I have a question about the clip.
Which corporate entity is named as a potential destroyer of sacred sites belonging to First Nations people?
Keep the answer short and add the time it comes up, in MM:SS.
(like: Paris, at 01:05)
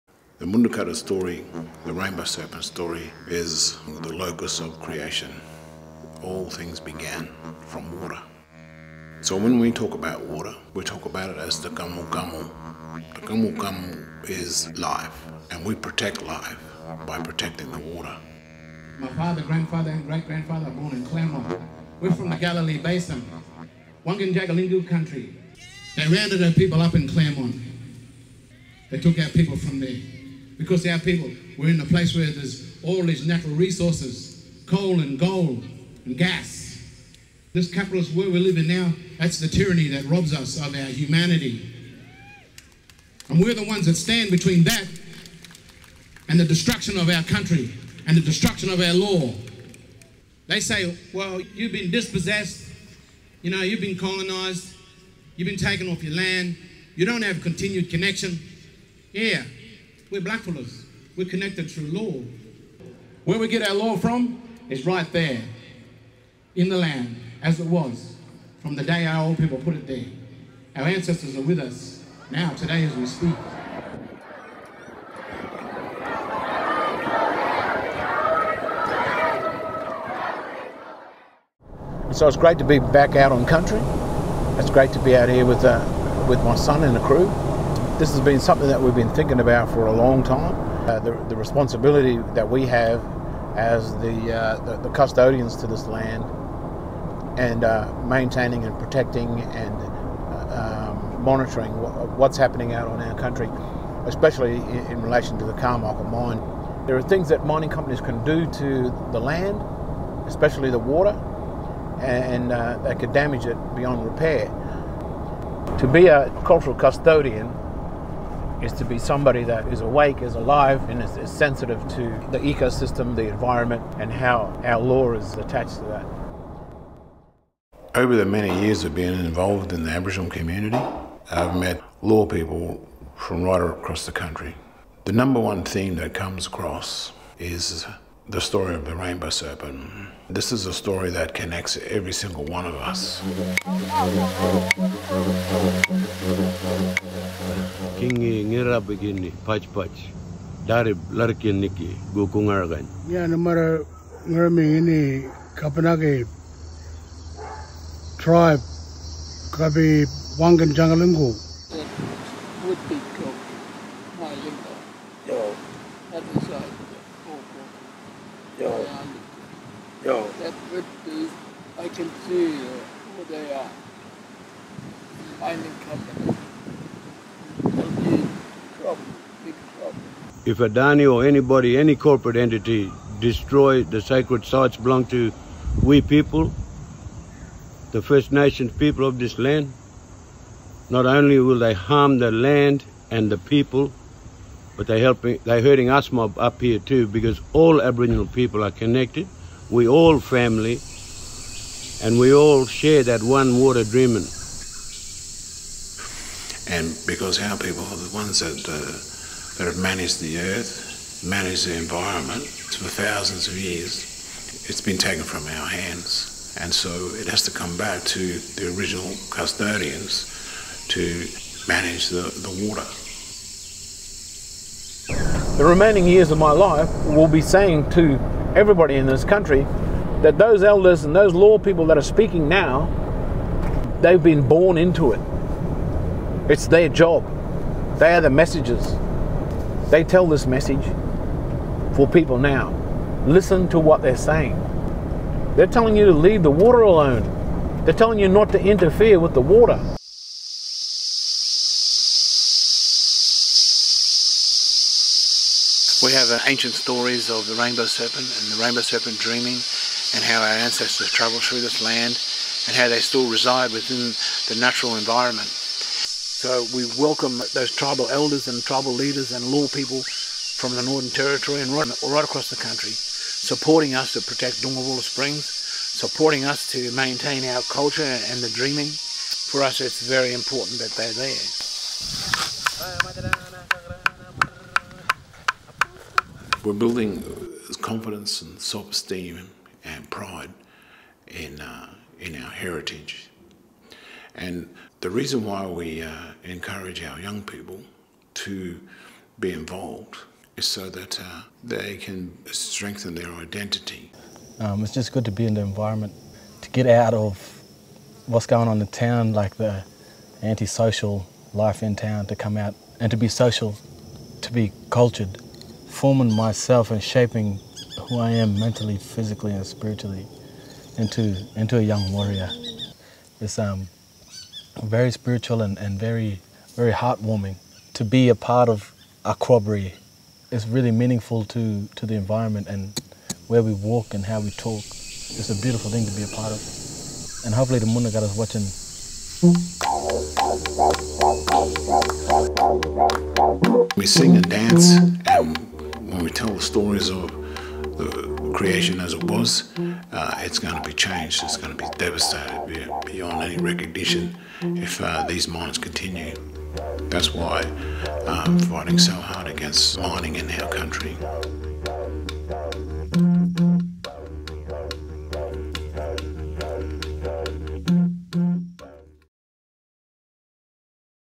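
Adani, at 03:00.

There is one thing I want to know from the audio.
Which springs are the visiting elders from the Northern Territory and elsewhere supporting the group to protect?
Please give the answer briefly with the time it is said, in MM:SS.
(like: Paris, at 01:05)
Doongmabulla Springs, at 04:34.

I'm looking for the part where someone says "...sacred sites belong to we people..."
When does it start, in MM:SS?
03:04.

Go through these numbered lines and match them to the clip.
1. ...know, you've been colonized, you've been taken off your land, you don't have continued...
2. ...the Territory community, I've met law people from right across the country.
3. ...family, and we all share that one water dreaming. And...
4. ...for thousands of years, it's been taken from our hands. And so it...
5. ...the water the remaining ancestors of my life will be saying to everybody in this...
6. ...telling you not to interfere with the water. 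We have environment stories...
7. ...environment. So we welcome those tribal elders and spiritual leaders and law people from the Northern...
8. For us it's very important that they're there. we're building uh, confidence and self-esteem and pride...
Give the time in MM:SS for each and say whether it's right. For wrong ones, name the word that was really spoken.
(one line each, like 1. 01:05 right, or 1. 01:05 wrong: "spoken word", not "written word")
1. 00:53 right
2. 02:09 wrong: "Aboriginal", not "Territory"
3. 03:20 right
4. 03:32 right
5. 03:42 wrong: "years", not "ancestors"
6. 04:07 wrong: "ancient", not "environment"
7. 04:24 wrong: "tribal", not "spiritual"
8. 04:39 right.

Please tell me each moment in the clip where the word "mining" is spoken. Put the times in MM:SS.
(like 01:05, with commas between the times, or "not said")
01:47, 02:55, 05:59.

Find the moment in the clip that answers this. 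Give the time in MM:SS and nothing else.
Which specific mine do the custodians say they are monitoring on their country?
01:45.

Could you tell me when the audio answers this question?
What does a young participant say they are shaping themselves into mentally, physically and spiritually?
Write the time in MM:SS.
05:21.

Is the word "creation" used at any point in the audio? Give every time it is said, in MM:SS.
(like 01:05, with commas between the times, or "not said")
00:04, 05:48.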